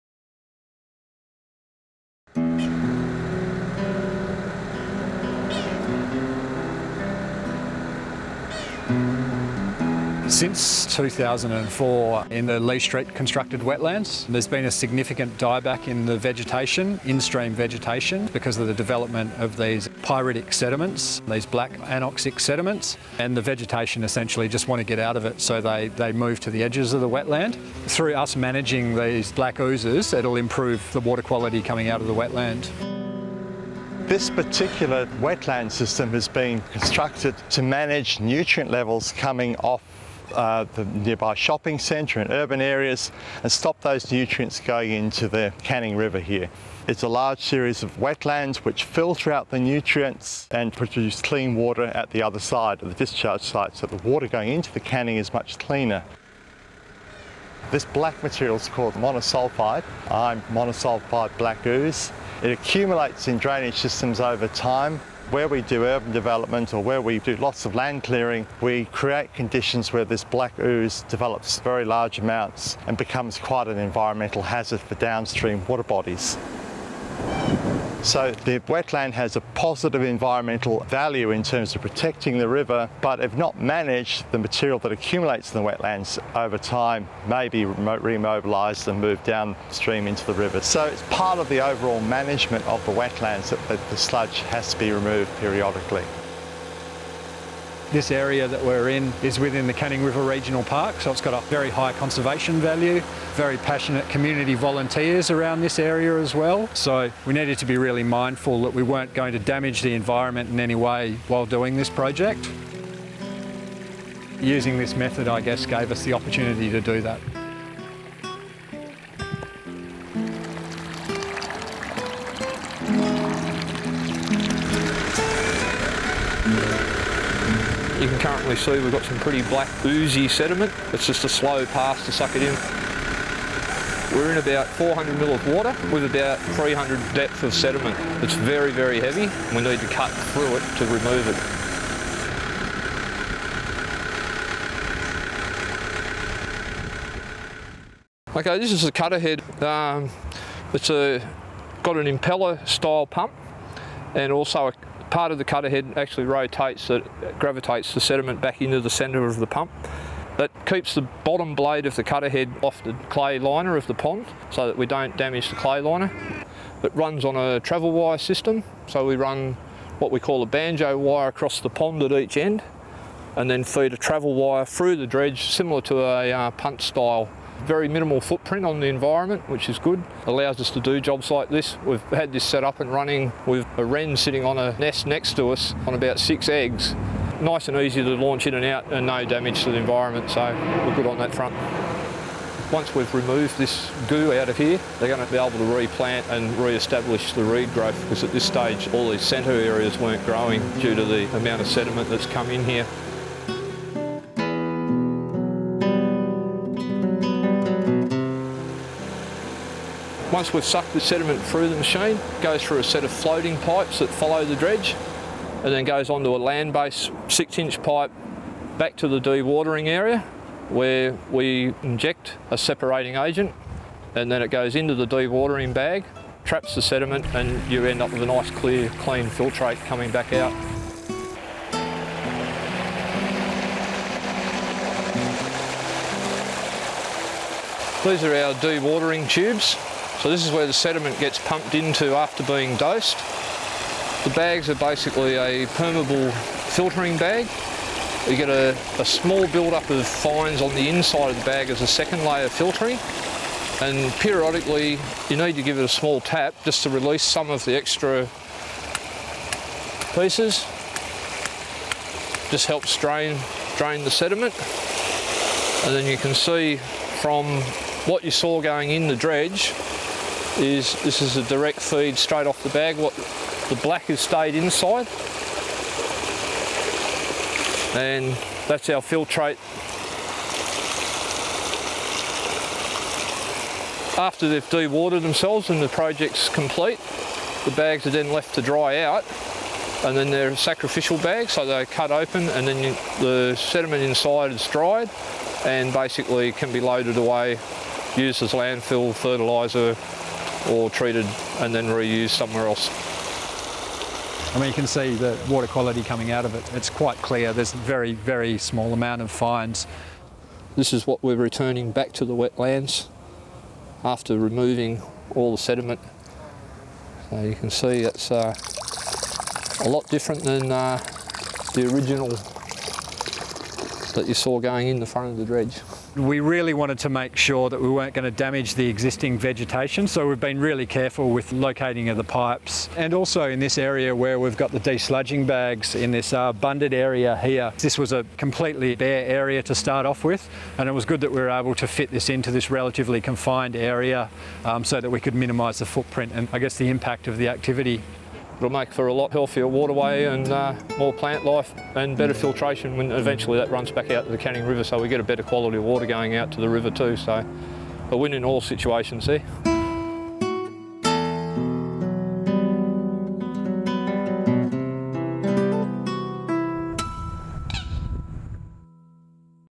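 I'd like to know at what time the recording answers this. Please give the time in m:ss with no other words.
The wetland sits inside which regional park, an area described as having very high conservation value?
1:39.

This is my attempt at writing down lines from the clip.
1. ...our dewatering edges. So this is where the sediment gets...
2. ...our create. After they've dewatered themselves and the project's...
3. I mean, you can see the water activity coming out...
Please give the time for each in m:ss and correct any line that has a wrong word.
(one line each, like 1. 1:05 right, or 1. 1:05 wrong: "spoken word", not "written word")
1. 3:58 wrong: "tubes", not "edges"
2. 4:38 wrong: "filtrate", not "create"
3. 5:04 wrong: "quality", not "activity".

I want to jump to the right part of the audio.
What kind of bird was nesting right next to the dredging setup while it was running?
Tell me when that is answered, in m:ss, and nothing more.
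3:03.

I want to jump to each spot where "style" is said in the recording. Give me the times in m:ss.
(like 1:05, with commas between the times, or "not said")
2:32, 2:56.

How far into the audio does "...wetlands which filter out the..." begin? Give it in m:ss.
0:47.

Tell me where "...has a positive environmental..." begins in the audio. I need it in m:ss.
1:19.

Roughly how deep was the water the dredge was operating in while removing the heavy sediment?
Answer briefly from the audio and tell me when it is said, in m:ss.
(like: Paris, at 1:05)
400 mm, at 2:14.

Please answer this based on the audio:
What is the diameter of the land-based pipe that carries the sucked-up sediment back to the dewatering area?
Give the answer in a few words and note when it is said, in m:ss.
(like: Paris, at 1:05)
6 inch, at 3:37.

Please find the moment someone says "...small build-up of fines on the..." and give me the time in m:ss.
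4:09.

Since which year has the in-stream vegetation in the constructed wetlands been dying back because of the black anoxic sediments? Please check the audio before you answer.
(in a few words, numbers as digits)
2004.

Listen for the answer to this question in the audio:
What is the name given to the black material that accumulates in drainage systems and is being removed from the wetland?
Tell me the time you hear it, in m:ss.
1:00.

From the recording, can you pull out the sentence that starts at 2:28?
Okay, this is a cutter head.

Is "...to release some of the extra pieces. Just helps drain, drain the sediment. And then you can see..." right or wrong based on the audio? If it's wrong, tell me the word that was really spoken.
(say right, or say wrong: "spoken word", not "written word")
right.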